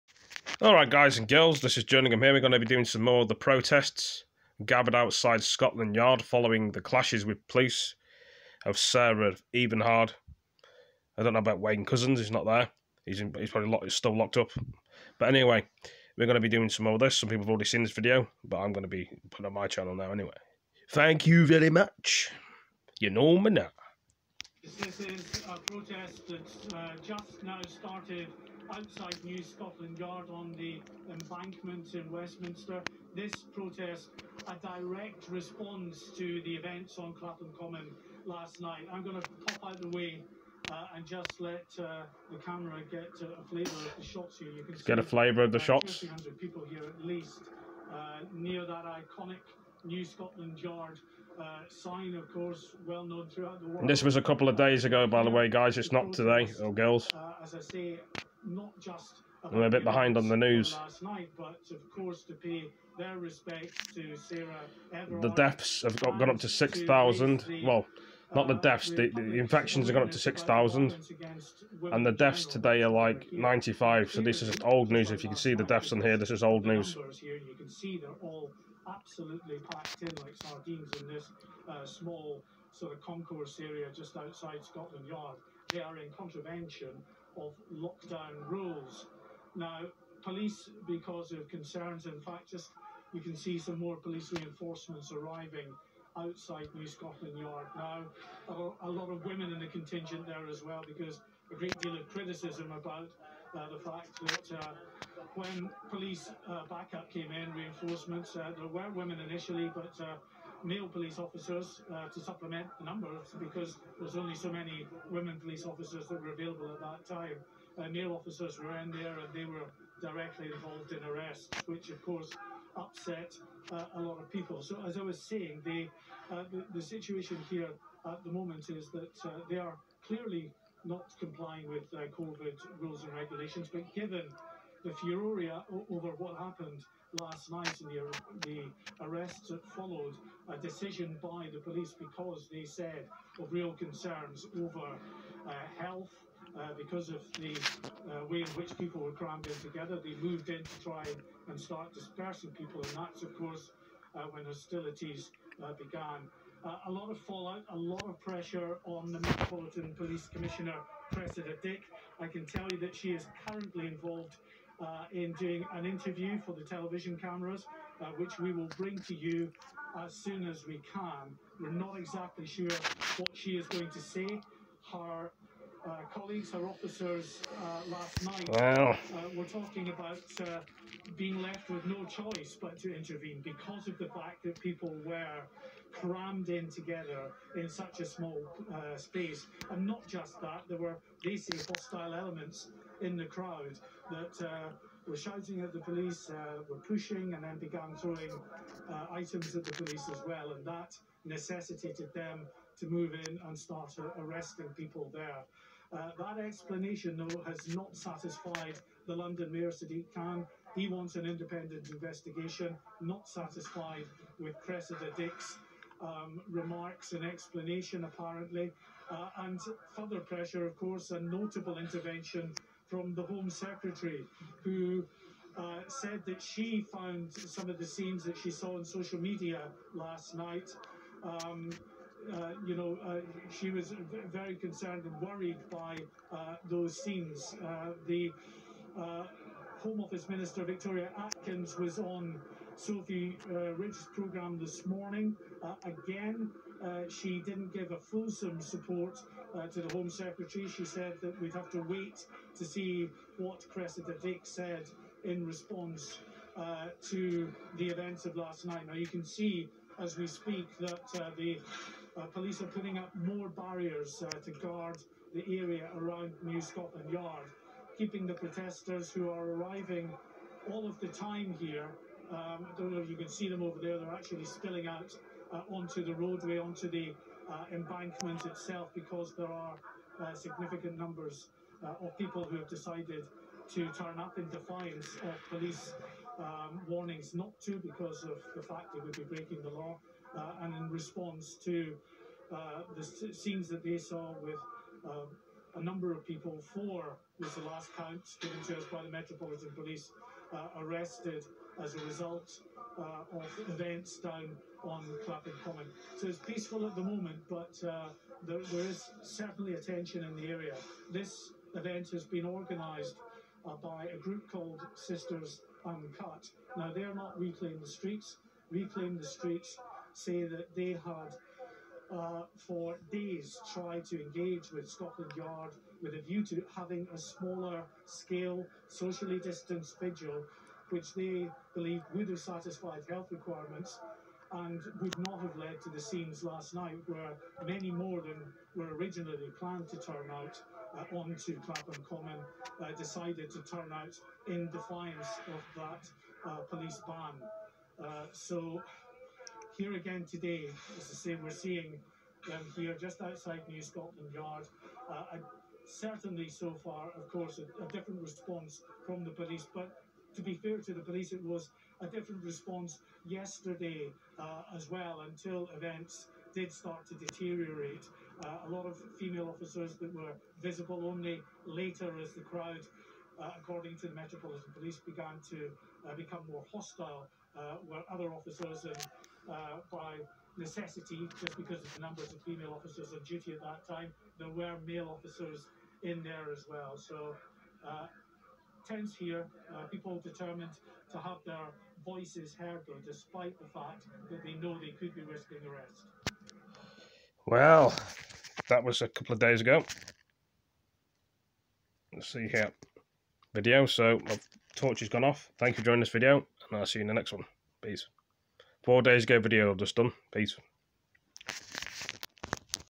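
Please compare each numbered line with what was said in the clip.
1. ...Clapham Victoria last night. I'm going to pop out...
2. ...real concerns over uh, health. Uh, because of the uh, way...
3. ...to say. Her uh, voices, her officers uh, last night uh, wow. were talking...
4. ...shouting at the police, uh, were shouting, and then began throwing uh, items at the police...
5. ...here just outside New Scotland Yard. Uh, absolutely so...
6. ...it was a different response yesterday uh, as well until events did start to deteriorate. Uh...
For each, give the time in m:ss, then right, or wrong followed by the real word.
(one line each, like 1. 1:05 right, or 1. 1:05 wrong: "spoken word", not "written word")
1. 0:37 wrong: "Common", not "Victoria"
2. 2:23 right
3. 2:53 wrong: "colleagues", not "voices"
4. 3:15 wrong: "pushing", not "shouting"
5. 5:52 wrong: "certainly", not "absolutely"
6. 6:01 right.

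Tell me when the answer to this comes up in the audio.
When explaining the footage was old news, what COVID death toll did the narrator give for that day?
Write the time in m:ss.
1:12.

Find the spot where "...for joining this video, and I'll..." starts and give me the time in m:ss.
6:45.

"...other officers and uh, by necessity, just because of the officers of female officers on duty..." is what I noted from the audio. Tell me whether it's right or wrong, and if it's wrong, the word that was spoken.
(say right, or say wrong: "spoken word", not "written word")
wrong: "numbers", not "officers".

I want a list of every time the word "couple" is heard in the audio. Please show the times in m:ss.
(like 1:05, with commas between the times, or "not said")
0:54, 6:39.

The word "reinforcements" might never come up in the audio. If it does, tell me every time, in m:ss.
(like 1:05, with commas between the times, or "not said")
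1:34, 1:47.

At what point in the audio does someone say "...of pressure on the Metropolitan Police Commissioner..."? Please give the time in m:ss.
2:38.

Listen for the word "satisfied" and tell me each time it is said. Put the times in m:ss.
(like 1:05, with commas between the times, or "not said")
3:27, 3:33, 5:32.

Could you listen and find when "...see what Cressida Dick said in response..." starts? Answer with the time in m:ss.
4:12.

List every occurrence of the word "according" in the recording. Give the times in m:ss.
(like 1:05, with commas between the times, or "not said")
6:13.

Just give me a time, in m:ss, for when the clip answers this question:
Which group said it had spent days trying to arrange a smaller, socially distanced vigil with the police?
5:18.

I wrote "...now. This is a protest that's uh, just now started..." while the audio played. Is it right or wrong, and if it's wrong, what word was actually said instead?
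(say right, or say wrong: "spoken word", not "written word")
right.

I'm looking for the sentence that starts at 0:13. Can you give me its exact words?
He's, in, he's probably locked, he's still locked up.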